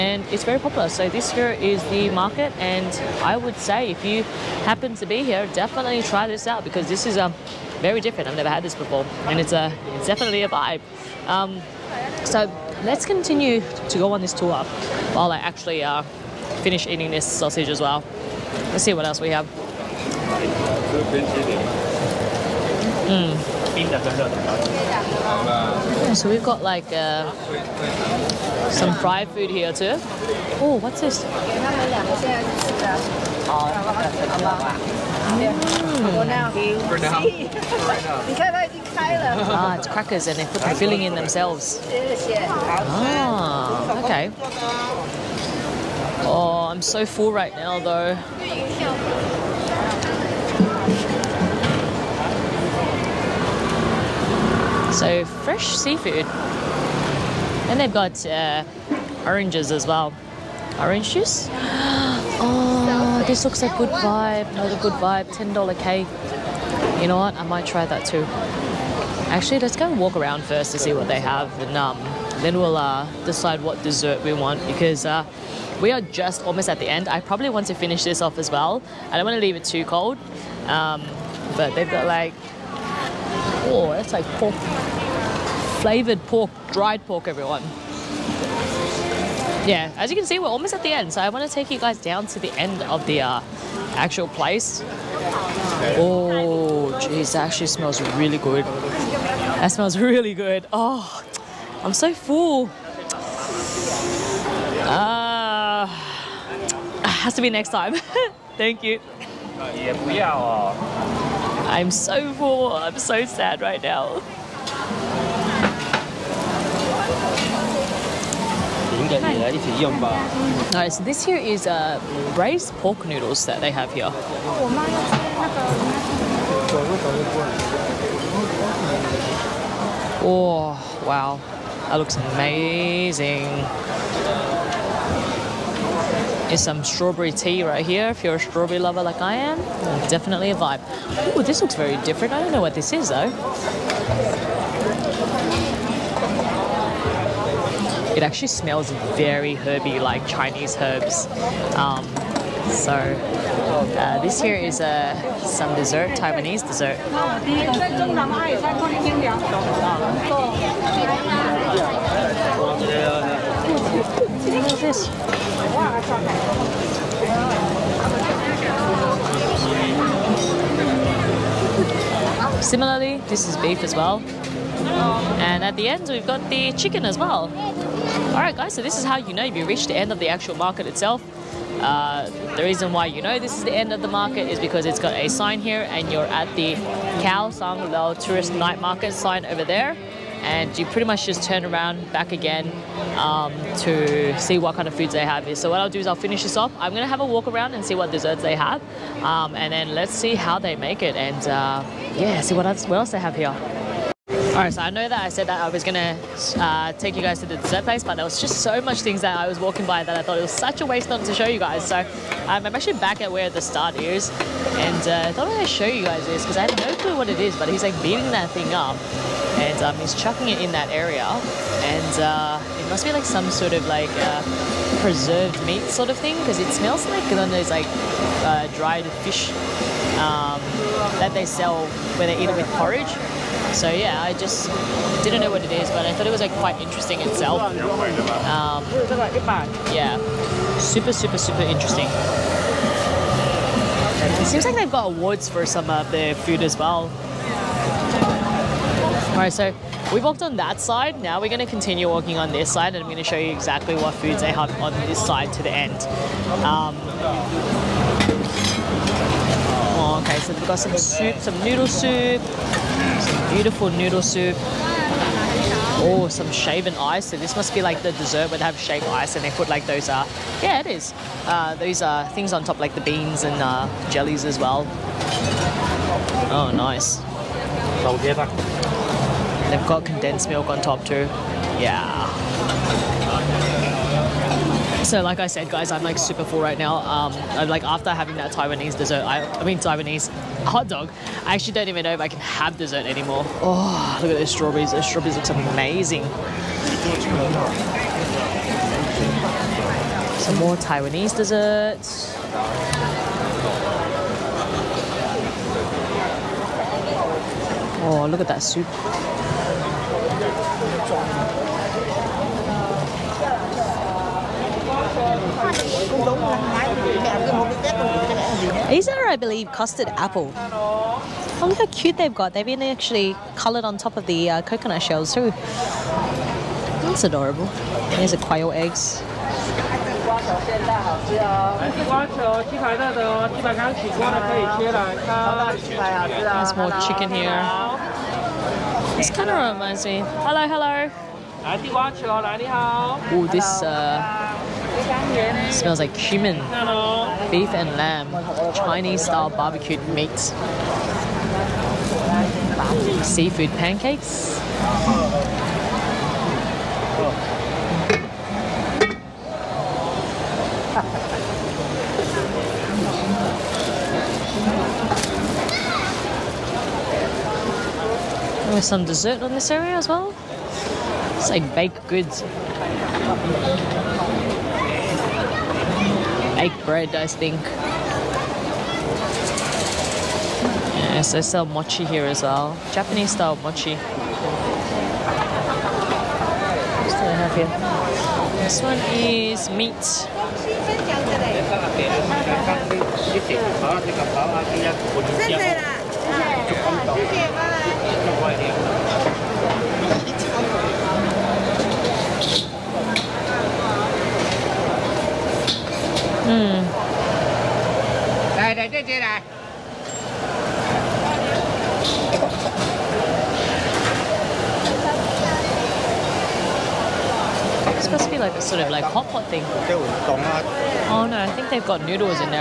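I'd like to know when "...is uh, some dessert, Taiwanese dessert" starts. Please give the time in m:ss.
2:34.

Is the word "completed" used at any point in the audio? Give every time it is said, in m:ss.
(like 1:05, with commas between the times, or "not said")
not said.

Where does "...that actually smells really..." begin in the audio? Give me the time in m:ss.
1:37.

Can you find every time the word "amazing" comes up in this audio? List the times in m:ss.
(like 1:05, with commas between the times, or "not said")
2:12, 4:55.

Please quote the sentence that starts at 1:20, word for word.
Um, but they've got like Oh, that's like pork, flavored pork, dried pork, everyone.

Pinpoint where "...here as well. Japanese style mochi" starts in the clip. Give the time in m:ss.
6:22.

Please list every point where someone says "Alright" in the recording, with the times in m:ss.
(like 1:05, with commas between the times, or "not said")
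1:59, 3:24, 4:09.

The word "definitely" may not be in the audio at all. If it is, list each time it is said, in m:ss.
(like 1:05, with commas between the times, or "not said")
0:05, 0:10, 2:20.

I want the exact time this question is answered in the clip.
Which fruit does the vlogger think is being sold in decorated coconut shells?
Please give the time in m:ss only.
5:19.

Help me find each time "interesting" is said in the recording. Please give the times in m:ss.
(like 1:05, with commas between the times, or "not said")
3:56, 4:01.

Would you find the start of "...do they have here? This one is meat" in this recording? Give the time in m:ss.
6:27.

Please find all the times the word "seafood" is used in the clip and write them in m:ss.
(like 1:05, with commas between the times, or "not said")
0:55, 5:53.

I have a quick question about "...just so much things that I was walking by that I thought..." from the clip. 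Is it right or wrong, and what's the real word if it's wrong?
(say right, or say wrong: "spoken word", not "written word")
right.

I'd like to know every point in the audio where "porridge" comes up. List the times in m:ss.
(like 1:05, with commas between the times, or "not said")
3:52.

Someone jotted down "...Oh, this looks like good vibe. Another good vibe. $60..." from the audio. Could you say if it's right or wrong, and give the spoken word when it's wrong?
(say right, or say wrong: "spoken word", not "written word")
wrong: "10", not "60".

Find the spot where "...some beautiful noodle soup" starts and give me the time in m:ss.
4:23.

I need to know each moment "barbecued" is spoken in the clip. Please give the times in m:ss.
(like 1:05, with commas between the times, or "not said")
5:49.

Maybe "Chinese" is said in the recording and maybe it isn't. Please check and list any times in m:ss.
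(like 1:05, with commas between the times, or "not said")
2:30, 5:48.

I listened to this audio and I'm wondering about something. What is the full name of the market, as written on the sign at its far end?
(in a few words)
Kaohsiung Liuhe Tourist Night Market.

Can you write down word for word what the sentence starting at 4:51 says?
I actually don't even know if I can have dessert anymore.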